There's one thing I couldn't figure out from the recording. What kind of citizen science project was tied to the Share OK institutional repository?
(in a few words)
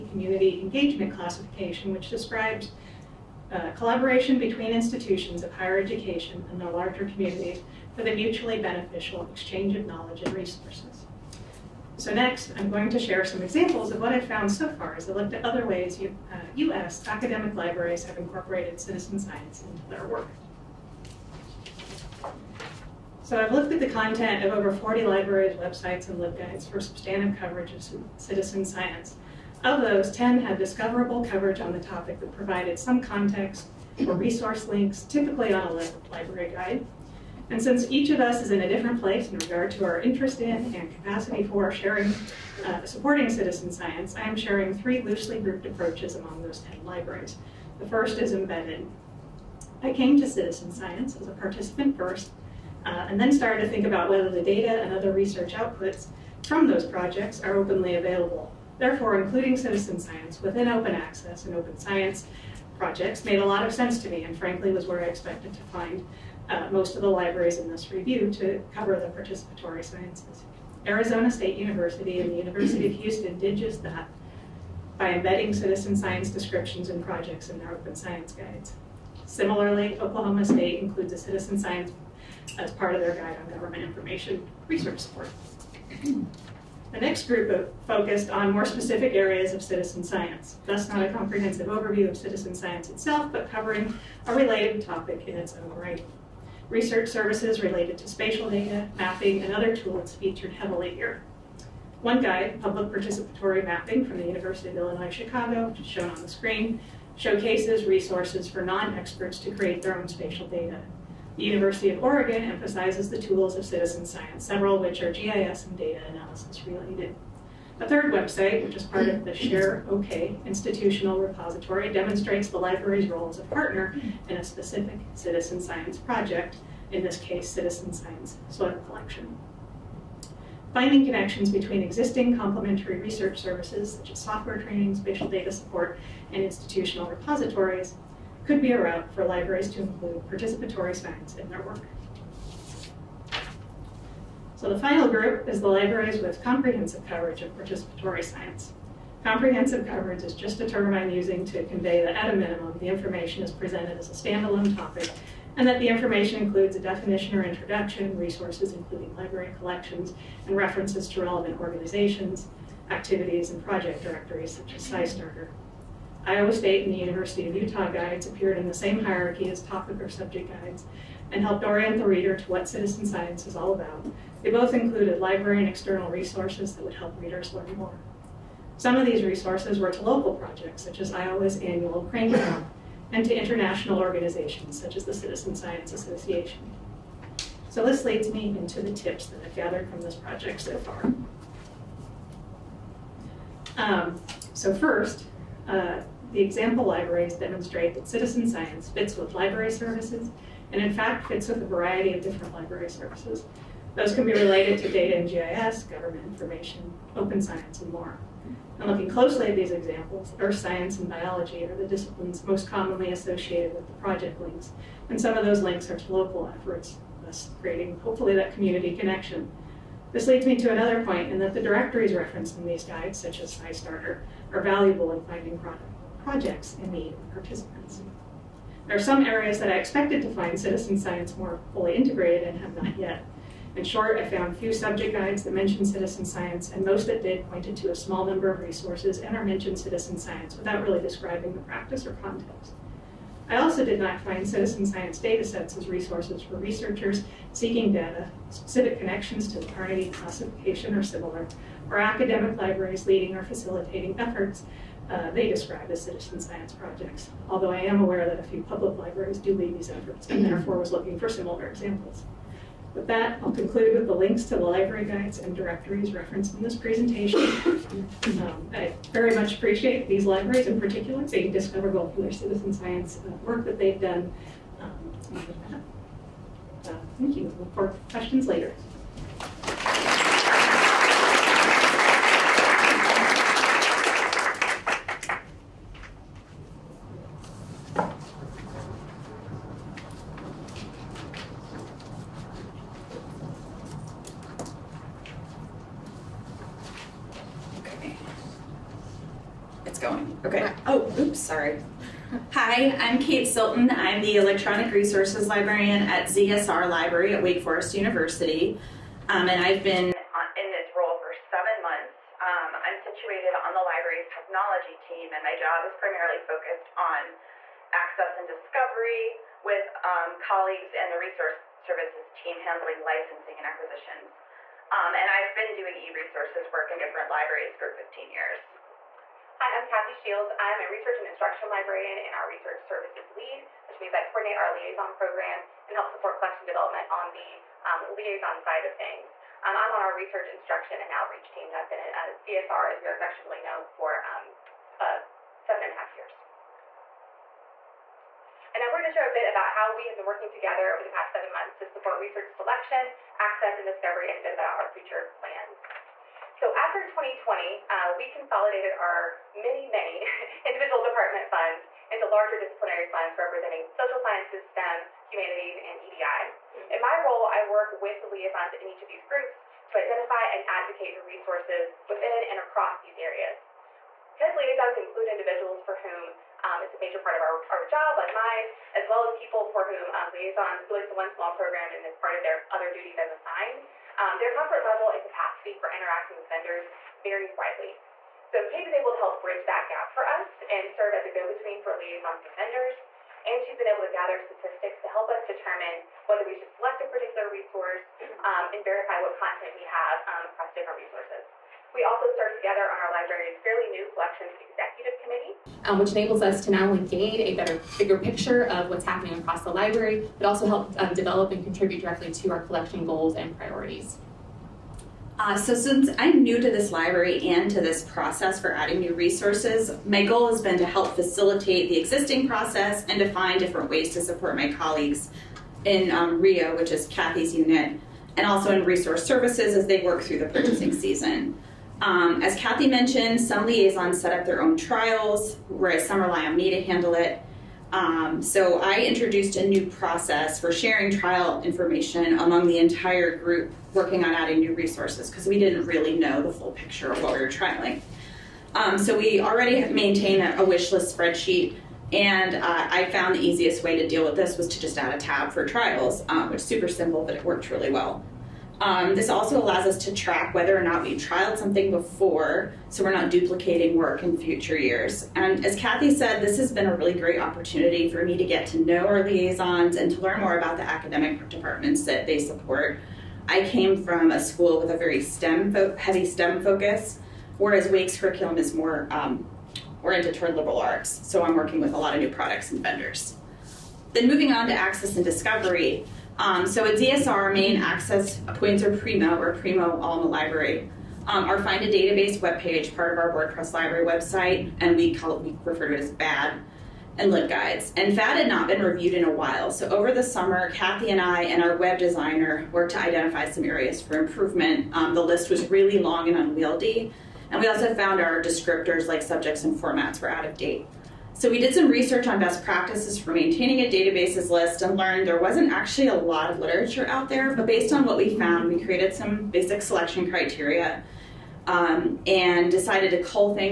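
Soil collection.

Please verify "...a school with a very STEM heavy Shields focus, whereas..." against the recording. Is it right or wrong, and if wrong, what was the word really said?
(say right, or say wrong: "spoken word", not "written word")
wrong: "STEM", not "Shields".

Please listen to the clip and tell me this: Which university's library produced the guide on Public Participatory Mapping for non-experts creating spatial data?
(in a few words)
University of Illinois Chicago.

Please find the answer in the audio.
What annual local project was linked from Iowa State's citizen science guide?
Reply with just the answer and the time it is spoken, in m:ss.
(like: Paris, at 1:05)
Crane Club, at 3:02.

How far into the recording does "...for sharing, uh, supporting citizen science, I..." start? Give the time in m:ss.
0:41.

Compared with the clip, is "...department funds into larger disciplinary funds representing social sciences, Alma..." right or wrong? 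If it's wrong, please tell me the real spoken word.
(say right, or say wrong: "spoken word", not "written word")
wrong: "STEM", not "Alma".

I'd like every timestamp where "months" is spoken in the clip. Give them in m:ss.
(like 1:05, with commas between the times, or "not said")
5:11, 5:51.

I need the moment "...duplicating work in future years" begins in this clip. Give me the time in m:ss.
7:43.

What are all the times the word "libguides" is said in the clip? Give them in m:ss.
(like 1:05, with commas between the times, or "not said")
0:26, 8:17.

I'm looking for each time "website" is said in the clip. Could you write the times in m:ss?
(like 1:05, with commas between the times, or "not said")
0:25, 1:58, 8:14.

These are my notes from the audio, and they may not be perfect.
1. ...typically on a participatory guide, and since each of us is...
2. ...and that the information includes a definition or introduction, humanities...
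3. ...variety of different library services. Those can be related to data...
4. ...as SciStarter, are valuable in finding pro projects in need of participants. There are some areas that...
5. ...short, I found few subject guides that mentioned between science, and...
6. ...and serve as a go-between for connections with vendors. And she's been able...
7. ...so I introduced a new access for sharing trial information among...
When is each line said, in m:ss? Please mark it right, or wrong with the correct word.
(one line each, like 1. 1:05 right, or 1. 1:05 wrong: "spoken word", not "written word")
1. 0:35 wrong: "library", not "participatory"
2. 2:35 wrong: "resources", not "humanities"
3. 3:21 right
4. 3:43 right
5. 3:53 wrong: "citizen", not "between"
6. 6:30 wrong: "liaisons", not "connections"
7. 7:18 wrong: "process", not "access".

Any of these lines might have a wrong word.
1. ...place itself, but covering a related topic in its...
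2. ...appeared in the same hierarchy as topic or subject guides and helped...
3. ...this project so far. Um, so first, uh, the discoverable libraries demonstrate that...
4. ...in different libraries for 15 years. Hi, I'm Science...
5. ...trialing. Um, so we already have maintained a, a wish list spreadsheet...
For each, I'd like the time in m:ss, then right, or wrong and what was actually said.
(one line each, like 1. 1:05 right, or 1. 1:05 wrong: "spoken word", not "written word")
1. 1:32 wrong: "science", not "place"
2. 2:48 right
3. 3:10 wrong: "example", not "discoverable"
4. 5:26 wrong: "Kathy", not "Science"
5. 7:27 right.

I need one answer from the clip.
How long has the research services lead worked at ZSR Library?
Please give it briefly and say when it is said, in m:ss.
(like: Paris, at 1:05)
Seven and a half years, at 5:45.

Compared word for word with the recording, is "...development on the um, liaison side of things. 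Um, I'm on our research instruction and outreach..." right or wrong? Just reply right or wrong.
right.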